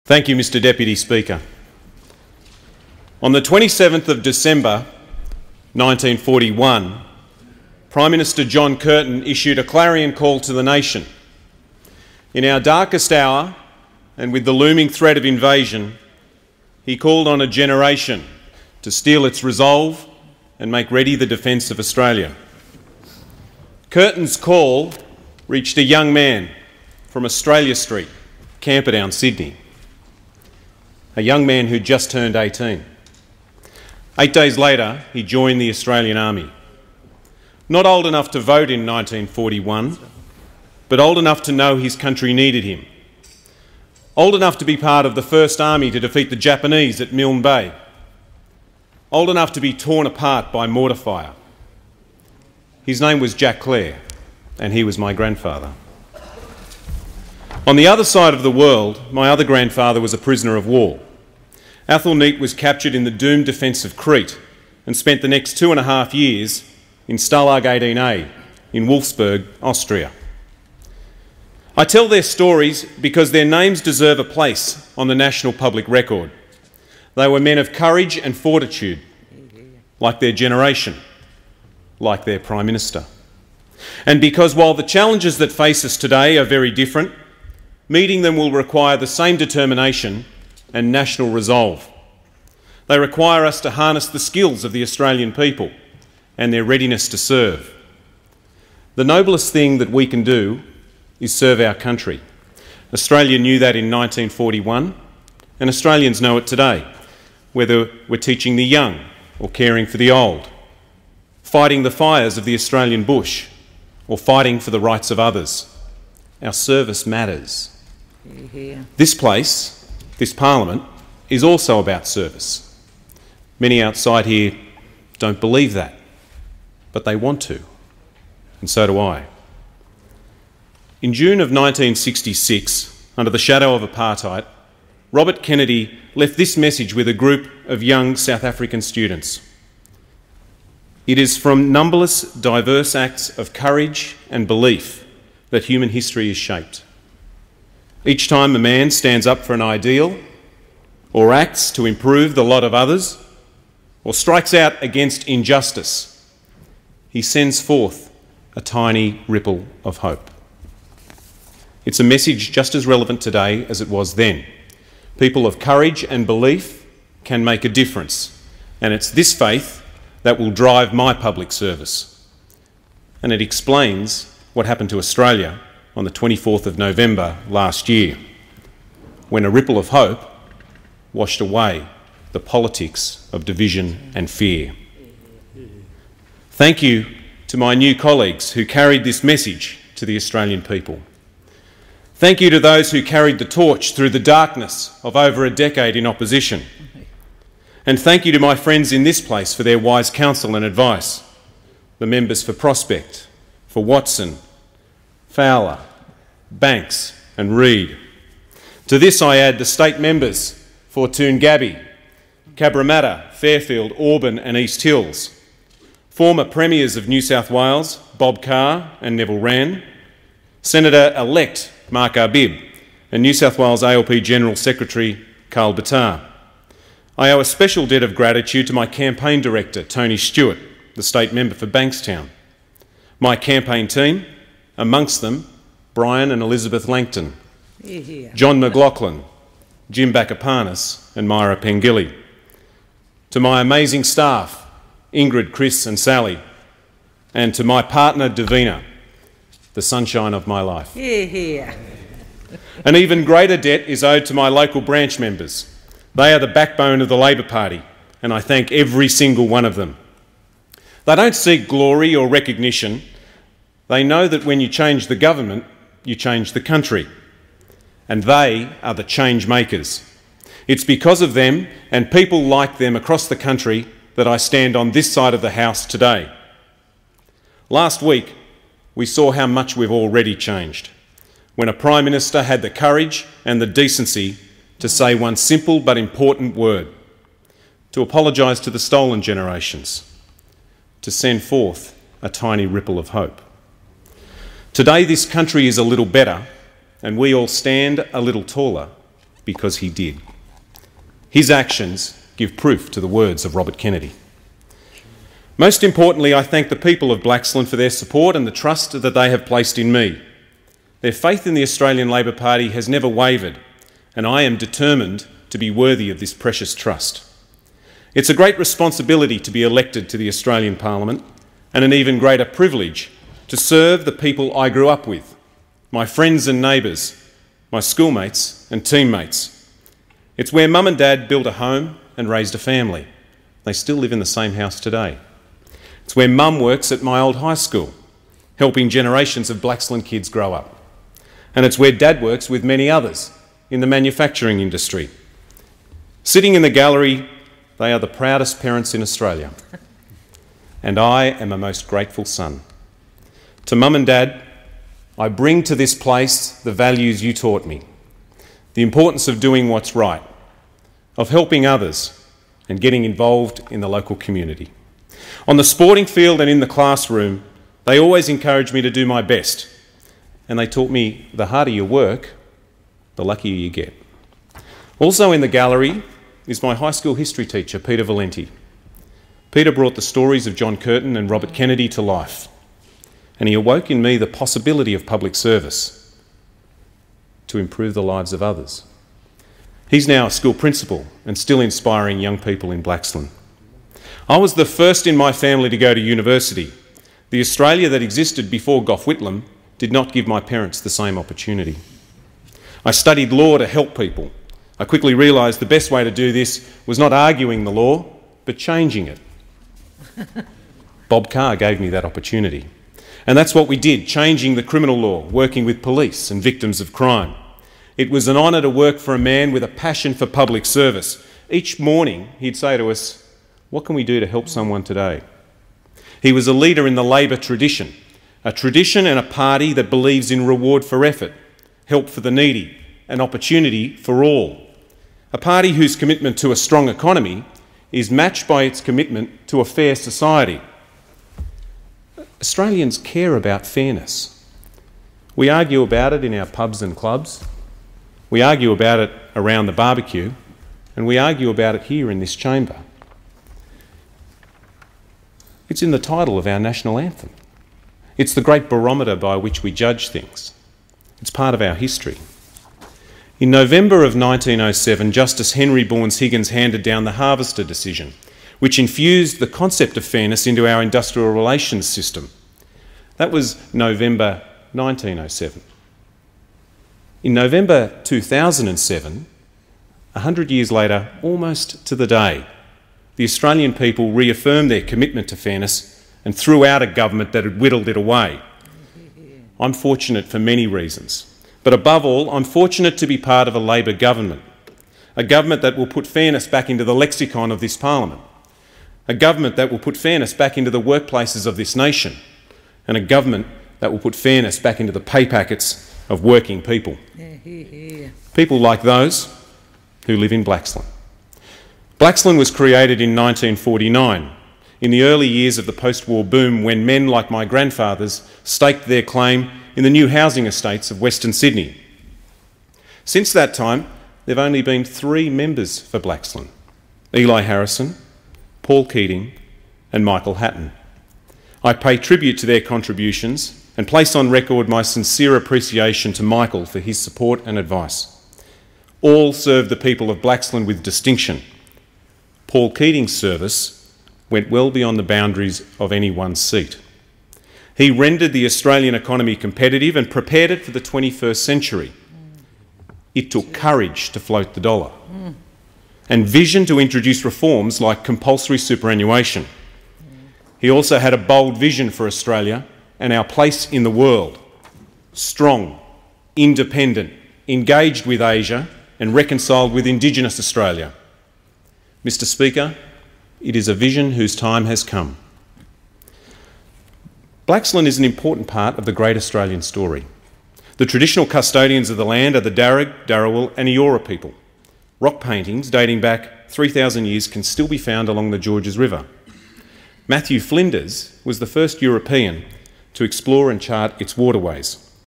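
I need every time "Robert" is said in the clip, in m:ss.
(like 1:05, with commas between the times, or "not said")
2:15, 5:03, 6:21.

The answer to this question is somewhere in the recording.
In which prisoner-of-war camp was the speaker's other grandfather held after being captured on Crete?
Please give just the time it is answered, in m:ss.
1:07.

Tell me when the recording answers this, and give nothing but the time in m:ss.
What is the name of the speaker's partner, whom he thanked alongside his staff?
4:08.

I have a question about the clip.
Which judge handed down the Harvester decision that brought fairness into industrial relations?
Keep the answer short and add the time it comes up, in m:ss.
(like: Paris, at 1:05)
Henry Bourne Higgins, at 7:45.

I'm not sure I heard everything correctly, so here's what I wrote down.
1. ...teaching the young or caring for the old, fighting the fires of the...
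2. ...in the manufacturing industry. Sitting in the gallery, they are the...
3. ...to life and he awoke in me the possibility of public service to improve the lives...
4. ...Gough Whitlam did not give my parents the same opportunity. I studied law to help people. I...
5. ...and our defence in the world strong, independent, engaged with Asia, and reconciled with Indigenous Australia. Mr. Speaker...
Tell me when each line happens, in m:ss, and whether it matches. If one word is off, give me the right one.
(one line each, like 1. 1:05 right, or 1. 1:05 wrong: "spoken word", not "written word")
1. 1:48 right
2. 5:43 right
3. 6:21 right
4. 6:38 right
5. 9:22 wrong: "place", not "defence".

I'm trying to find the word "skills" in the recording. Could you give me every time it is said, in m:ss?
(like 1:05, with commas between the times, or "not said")
1:34.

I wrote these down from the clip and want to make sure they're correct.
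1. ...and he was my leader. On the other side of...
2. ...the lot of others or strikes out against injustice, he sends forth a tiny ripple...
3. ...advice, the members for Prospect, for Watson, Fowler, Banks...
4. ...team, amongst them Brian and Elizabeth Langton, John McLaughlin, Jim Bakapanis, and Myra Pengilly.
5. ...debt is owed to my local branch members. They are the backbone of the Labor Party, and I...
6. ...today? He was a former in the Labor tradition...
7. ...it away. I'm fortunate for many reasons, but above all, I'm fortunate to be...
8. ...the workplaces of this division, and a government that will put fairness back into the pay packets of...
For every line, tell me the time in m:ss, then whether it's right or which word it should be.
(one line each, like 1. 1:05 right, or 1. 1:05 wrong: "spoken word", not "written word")
1. 0:54 wrong: "grandfather", not "leader"
2. 2:32 right
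3. 3:20 right
4. 3:53 right
5. 4:13 right
6. 7:04 wrong: "leader", not "former"
7. 8:07 right
8. 8:20 wrong: "nation", not "division".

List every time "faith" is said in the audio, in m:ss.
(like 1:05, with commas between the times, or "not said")
2:49, 5:11.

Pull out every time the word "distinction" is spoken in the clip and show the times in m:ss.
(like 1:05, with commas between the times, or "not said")
9:00.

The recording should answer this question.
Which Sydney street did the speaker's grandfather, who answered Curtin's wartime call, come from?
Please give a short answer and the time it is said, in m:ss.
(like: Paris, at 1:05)
Australia Street, at 0:27.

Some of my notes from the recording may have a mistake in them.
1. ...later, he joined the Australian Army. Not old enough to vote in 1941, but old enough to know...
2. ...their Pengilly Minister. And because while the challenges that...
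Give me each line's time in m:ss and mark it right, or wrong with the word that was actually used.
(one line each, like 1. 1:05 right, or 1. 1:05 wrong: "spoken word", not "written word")
1. 0:34 right
2. 1:22 wrong: "Prime", not "Pengilly".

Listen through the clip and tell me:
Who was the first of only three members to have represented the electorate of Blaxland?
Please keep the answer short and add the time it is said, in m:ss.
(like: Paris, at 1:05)
Eli Harrison, at 8:47.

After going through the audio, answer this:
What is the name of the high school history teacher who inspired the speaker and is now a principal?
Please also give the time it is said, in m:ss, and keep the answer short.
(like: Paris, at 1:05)
Peter Valenti, at 6:17.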